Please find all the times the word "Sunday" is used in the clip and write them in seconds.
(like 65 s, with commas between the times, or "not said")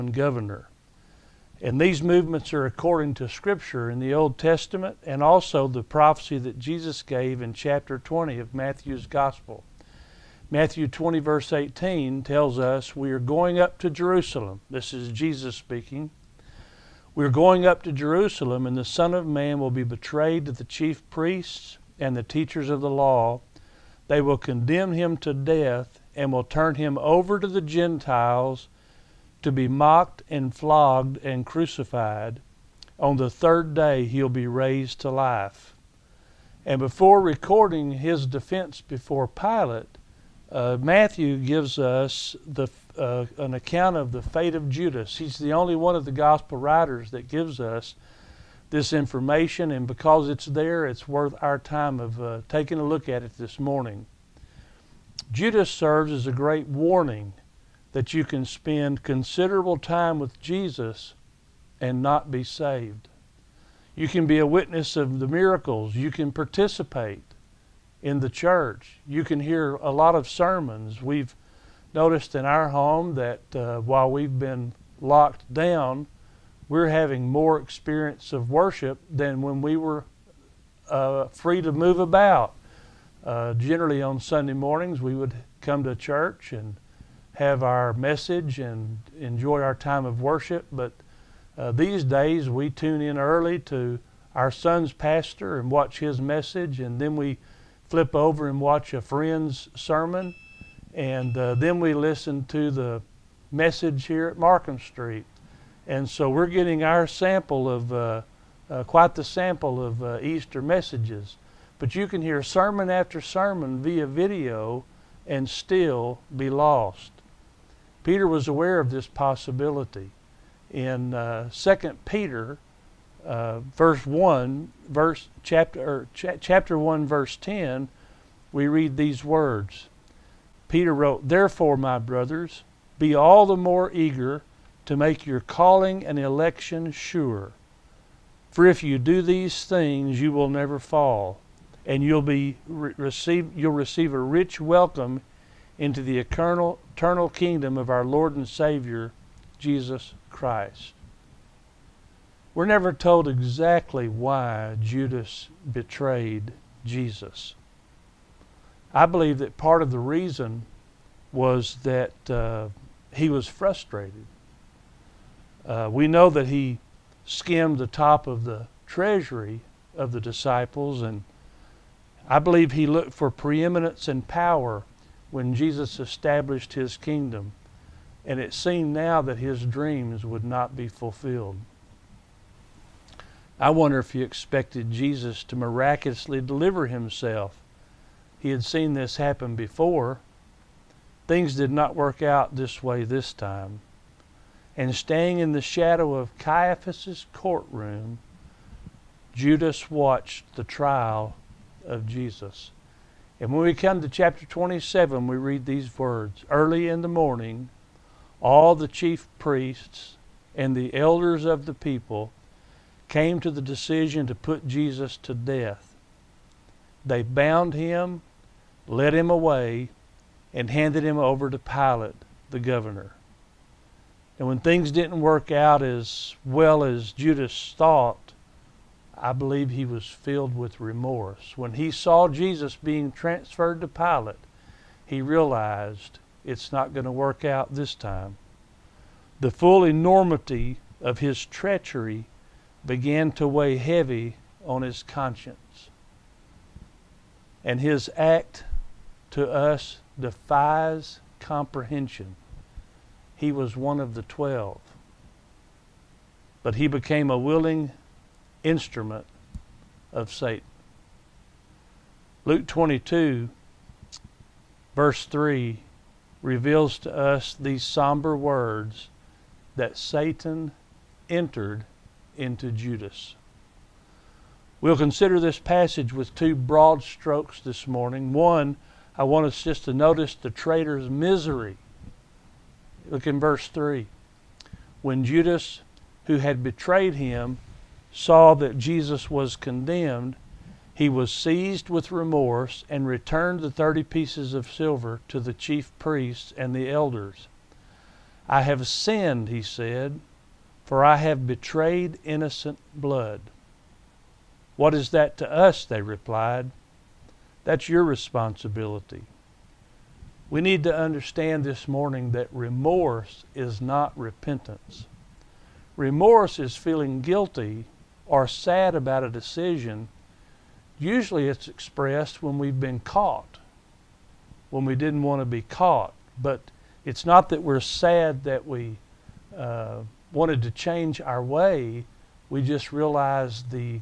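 84 s.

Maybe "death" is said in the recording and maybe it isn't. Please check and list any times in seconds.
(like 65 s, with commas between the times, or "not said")
25 s, 215 s.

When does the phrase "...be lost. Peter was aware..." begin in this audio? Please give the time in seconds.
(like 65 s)
116 s.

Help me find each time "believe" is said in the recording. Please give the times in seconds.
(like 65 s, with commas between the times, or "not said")
159 s, 172 s, 229 s.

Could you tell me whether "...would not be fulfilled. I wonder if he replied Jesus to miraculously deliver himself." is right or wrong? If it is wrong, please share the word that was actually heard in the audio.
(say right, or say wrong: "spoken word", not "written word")
wrong: "expected", not "replied".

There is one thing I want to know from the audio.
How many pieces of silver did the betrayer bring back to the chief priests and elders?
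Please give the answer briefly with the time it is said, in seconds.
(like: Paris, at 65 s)
30, at 293 s.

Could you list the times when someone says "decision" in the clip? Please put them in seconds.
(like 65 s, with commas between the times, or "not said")
213 s, 319 s.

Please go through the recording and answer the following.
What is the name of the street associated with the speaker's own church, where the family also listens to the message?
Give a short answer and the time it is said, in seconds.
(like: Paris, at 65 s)
Markham Street, at 104 s.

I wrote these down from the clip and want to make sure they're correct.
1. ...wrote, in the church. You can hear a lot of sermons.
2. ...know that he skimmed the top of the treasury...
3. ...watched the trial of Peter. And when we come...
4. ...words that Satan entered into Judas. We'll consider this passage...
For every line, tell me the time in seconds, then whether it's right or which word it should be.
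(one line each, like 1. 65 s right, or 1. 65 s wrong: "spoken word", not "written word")
1. 66 s wrong: "participate", not "wrote"
2. 166 s right
3. 199 s wrong: "Jesus", not "Peter"
4. 268 s right.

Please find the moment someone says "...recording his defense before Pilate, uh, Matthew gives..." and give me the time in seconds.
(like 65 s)
37 s.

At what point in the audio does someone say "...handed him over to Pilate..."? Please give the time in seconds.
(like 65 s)
220 s.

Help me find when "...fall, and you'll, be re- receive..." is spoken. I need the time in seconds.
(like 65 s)
140 s.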